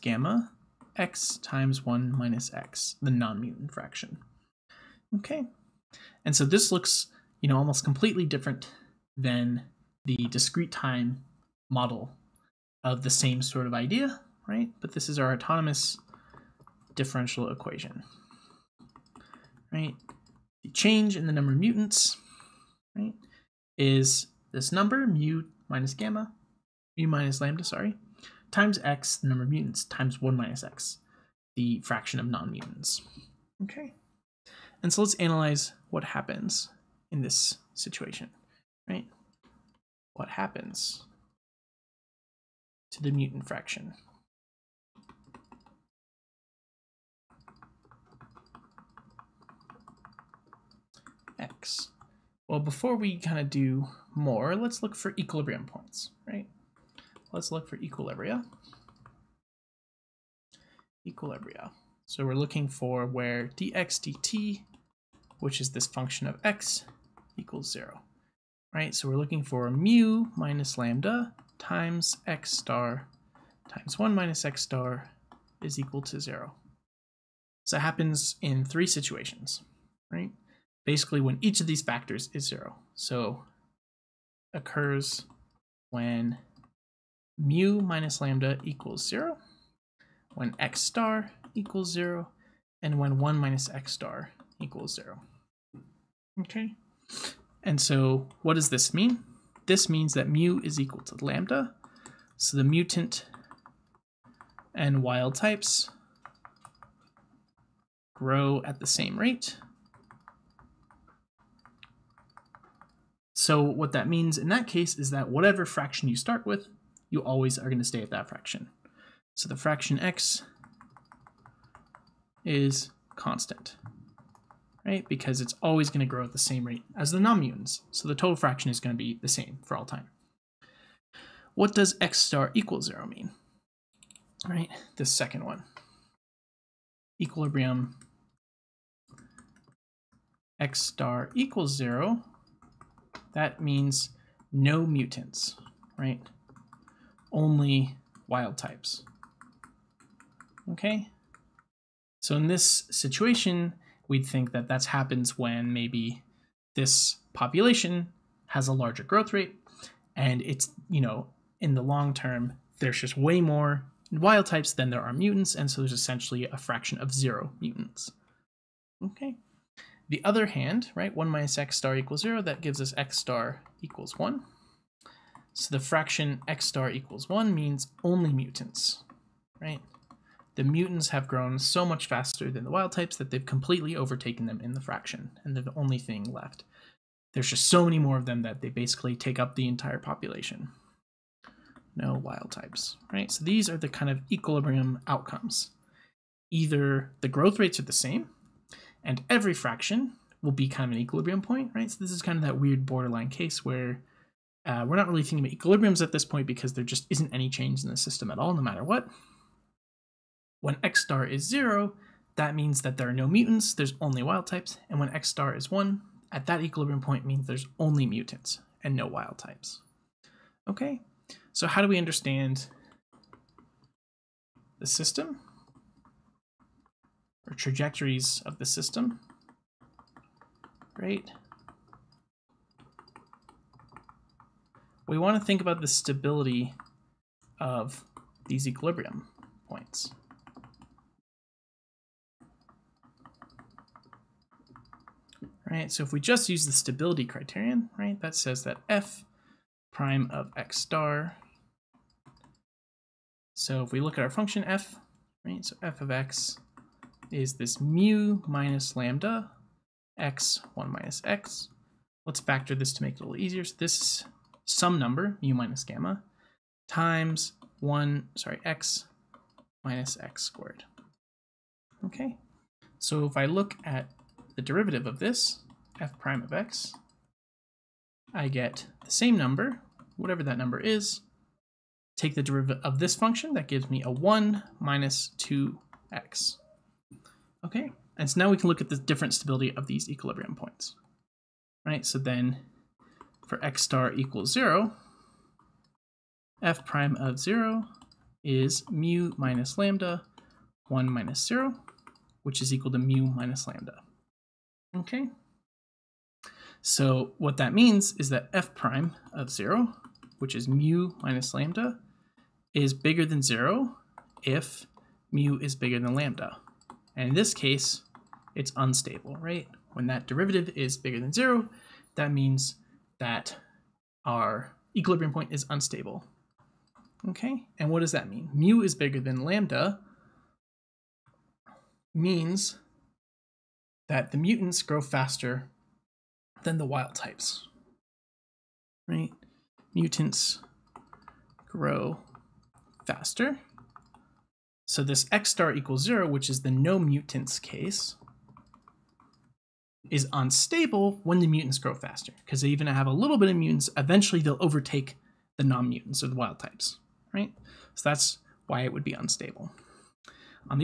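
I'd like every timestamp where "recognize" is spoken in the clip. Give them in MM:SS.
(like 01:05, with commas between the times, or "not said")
not said.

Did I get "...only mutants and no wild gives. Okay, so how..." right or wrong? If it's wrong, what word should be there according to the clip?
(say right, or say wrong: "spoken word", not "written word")
wrong: "types", not "gives".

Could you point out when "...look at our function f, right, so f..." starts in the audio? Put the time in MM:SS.
04:13.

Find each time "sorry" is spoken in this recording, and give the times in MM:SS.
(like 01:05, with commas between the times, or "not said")
00:27, 04:28.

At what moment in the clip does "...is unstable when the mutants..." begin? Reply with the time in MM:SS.
05:50.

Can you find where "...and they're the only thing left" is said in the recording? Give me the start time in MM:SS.
03:05.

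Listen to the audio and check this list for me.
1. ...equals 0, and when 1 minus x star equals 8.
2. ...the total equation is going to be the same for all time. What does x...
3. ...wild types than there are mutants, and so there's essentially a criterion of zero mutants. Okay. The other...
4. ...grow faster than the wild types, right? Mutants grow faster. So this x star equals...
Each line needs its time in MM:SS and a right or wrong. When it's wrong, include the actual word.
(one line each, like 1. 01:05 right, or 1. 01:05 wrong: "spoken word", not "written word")
1. 01:31 wrong: "0", not "8"
2. 02:08 wrong: "fraction", not "equation"
3. 02:44 wrong: "fraction", not "criterion"
4. 05:34 right.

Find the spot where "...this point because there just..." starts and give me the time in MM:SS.
03:26.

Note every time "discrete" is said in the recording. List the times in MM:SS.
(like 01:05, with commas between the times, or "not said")
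00:10.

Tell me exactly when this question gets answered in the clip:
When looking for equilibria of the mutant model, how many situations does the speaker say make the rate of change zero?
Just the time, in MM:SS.
01:18.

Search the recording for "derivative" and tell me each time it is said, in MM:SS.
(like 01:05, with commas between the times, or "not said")
04:34, 04:42, 05:20.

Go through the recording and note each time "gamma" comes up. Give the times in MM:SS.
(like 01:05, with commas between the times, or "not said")
00:25, 04:25.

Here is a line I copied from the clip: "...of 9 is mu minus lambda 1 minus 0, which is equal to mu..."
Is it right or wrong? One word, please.
wrong.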